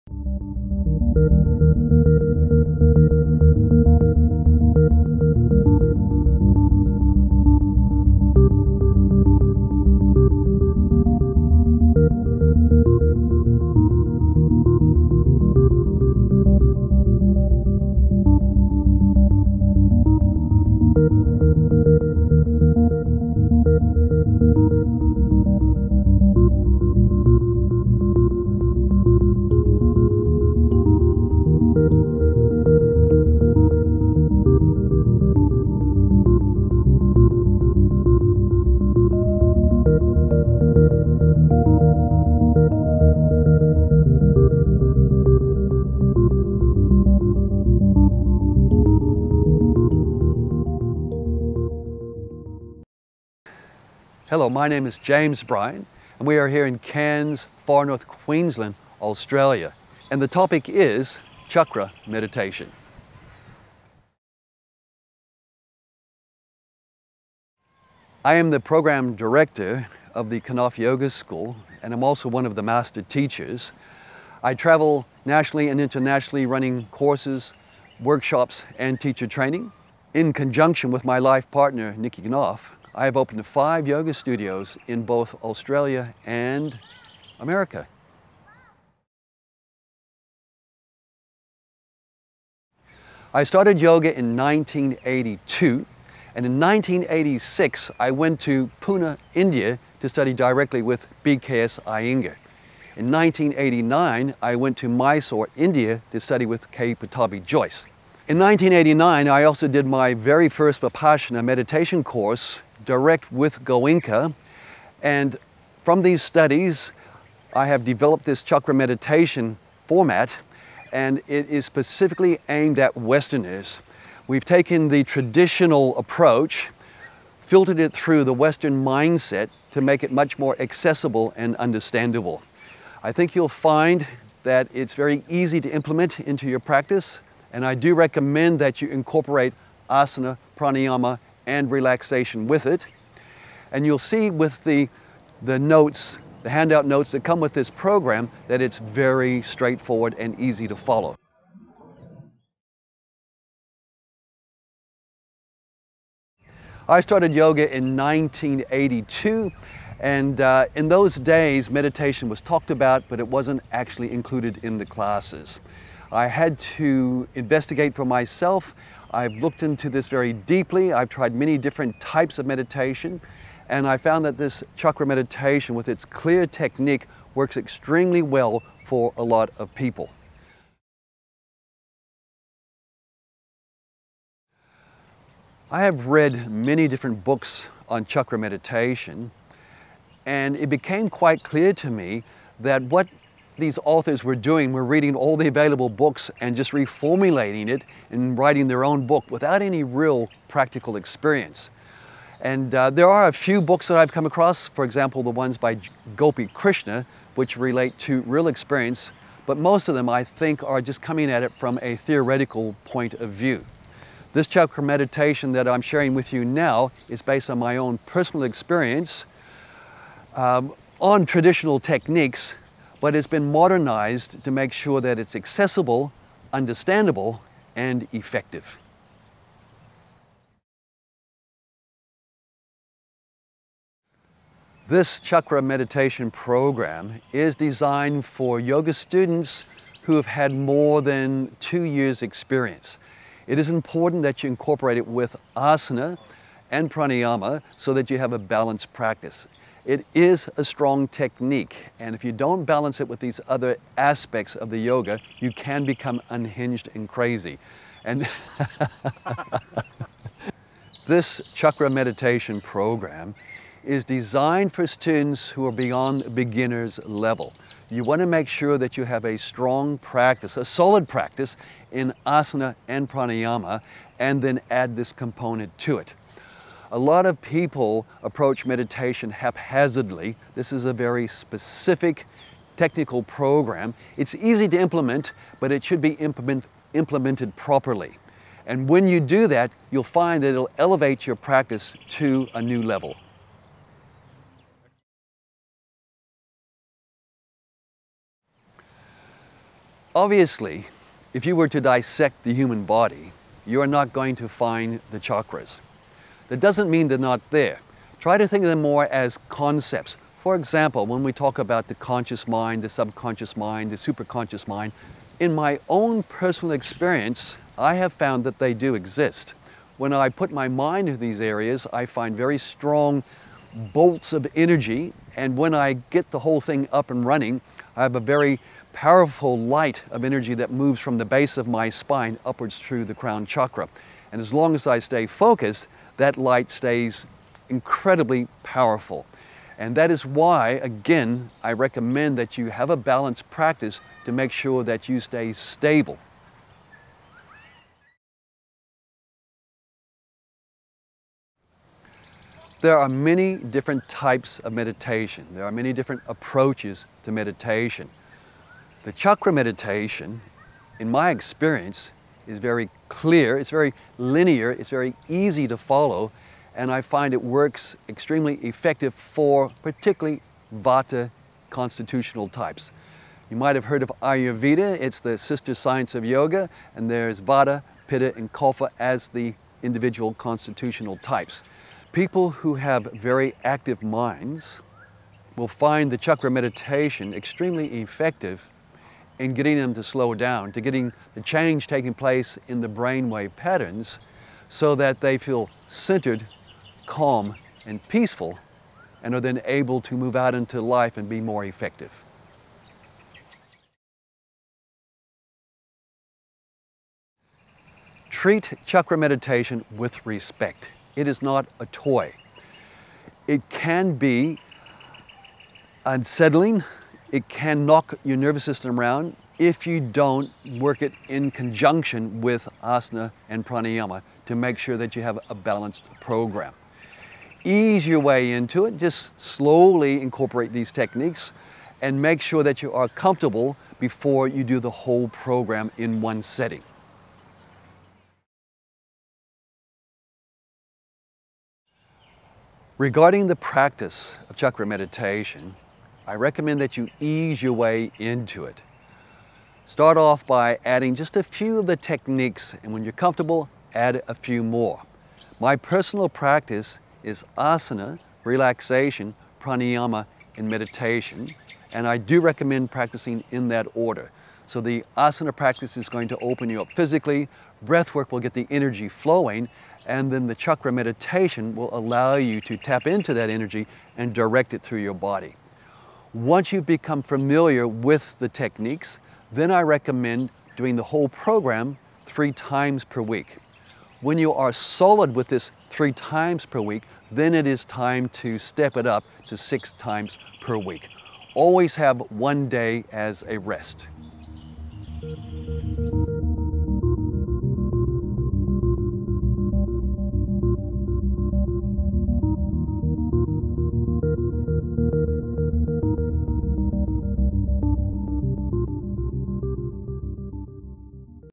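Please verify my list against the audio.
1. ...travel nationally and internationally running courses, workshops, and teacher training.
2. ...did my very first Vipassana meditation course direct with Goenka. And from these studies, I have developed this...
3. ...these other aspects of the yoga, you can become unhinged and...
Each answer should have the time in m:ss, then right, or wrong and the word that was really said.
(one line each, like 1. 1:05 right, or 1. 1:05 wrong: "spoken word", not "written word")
1. 1:14 right
2. 1:49 right
3. 4:13 right.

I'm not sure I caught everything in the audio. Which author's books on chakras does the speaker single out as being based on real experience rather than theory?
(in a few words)
Gopi Krishna.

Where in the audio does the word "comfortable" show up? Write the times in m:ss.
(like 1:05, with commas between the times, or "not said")
7:13, 7:33.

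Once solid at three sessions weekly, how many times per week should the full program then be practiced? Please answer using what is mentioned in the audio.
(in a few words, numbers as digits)
6.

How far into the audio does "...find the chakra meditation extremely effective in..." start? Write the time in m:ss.
6:25.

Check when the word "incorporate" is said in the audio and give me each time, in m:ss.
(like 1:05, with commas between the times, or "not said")
2:18, 4:04, 7:10.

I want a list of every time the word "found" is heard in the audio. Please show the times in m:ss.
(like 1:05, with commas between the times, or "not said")
2:53, 5:18.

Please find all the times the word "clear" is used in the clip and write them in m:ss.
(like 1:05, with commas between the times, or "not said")
2:56, 3:11, 6:03.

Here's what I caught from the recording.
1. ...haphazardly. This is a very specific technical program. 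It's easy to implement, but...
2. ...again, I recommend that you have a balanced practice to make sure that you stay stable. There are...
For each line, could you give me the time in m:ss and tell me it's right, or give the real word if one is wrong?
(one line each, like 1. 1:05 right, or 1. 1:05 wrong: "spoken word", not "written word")
1. 4:39 right
2. 5:40 right.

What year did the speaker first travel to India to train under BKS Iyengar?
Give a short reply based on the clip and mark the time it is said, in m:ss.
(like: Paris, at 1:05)
1986, at 1:36.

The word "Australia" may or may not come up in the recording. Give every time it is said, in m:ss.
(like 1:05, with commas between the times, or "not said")
0:59, 1:25.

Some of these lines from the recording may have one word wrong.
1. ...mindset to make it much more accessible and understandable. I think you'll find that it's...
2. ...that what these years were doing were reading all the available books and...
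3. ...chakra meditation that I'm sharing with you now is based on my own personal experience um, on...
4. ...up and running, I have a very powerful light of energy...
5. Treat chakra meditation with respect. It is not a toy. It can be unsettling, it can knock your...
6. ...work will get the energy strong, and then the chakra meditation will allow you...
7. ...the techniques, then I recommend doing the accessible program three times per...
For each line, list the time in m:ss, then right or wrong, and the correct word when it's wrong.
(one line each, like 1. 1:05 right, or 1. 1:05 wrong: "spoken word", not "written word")
1. 2:08 right
2. 3:12 wrong: "authors", not "years"
3. 3:34 right
4. 5:26 right
5. 6:48 right
6. 7:48 wrong: "flowing", not "strong"
7. 7:58 wrong: "whole", not "accessible".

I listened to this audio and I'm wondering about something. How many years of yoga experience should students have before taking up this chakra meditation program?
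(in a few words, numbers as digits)
more than 2 years.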